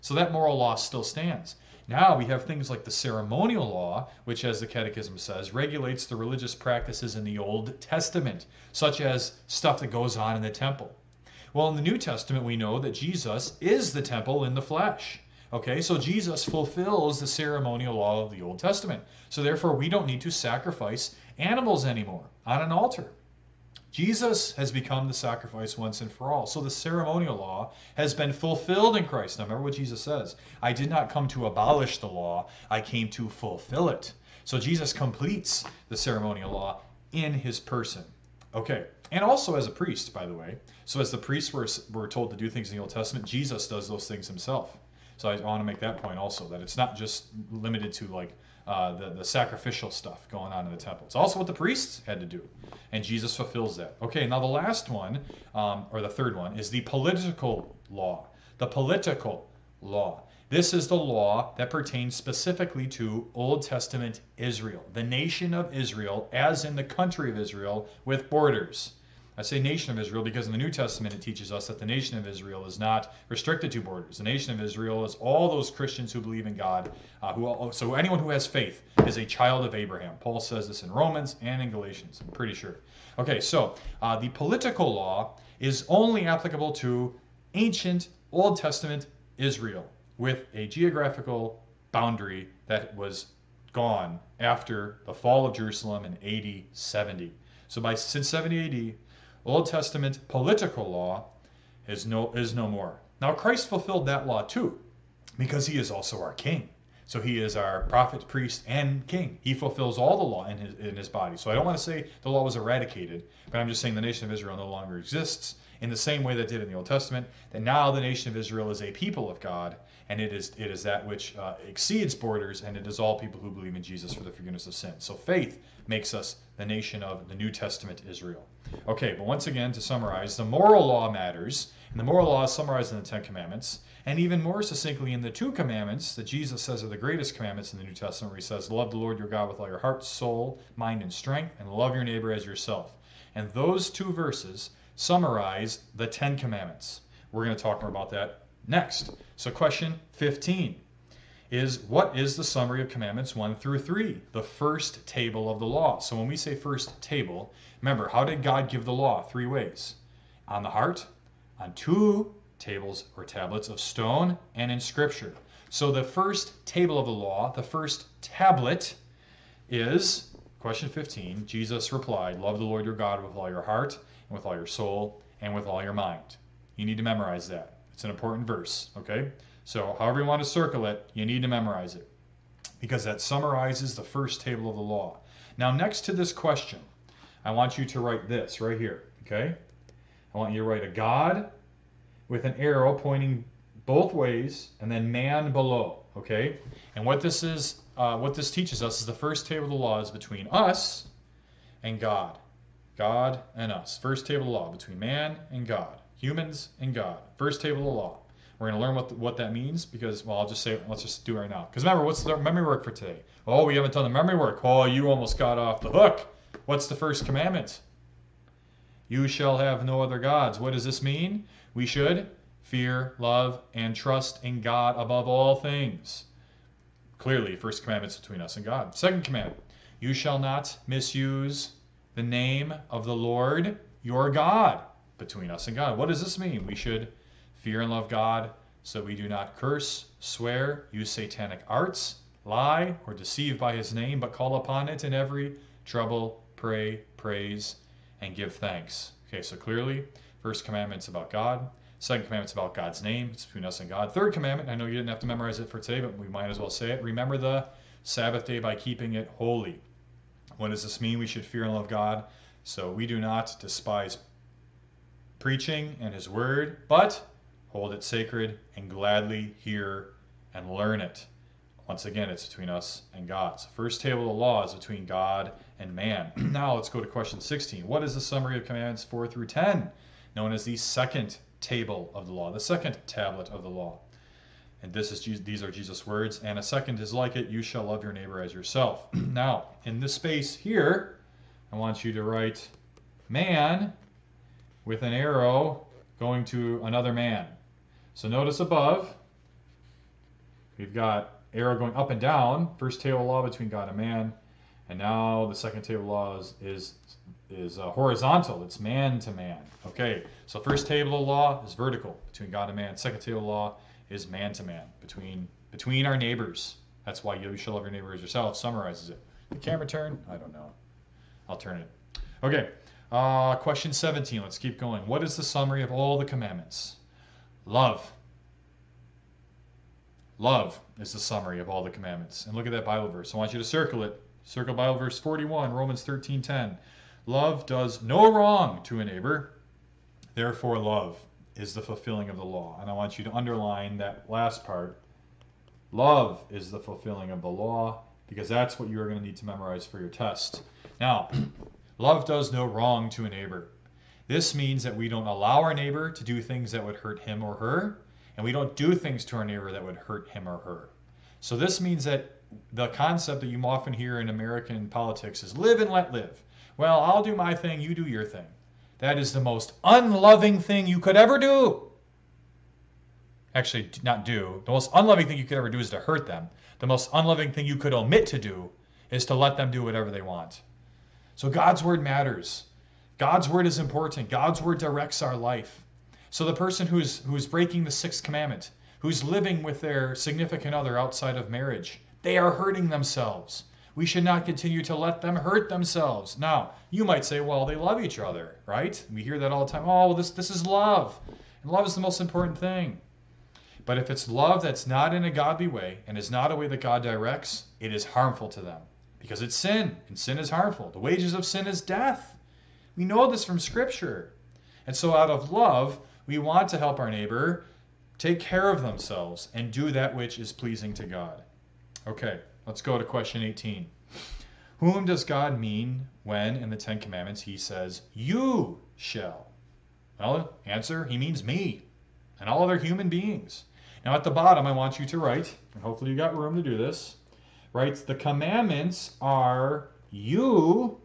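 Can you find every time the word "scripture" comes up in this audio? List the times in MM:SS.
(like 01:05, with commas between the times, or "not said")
02:44, 06:53.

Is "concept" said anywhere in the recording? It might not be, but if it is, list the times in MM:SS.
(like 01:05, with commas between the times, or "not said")
06:02.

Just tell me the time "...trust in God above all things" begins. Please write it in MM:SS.
03:43.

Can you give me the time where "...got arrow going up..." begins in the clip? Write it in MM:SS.
05:00.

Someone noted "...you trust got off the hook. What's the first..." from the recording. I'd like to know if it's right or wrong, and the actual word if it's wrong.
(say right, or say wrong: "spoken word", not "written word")
wrong: "almost", not "trust".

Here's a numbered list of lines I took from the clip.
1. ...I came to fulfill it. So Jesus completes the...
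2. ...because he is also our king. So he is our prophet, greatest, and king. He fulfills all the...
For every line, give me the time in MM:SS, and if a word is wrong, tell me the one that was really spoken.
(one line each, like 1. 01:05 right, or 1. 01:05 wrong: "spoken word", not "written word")
1. 00:32 right
2. 01:45 wrong: "priest", not "greatest".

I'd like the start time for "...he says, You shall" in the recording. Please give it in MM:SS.
07:07.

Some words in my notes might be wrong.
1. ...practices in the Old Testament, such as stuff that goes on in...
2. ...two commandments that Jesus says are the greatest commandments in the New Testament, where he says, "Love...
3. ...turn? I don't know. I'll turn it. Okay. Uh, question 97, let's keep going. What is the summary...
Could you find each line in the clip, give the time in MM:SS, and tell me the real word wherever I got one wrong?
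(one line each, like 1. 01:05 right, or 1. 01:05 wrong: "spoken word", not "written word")
1. 00:06 right
2. 02:15 right
3. 05:19 wrong: "17", not "97".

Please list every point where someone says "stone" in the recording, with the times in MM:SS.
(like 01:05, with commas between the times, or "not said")
02:43.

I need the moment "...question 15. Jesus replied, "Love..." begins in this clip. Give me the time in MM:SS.
02:50.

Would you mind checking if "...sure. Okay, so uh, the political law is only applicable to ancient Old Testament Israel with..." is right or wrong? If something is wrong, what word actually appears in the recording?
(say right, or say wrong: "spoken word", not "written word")
right.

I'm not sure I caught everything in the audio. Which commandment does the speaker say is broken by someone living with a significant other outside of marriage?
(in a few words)
The sixth.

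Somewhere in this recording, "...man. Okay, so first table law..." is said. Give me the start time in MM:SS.
05:09.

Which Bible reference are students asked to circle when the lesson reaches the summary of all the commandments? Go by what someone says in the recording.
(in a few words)
Romans 13:10.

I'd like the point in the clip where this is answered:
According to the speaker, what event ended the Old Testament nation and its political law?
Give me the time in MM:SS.
01:35.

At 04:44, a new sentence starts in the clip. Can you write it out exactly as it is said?
And this is these are Jesus' words.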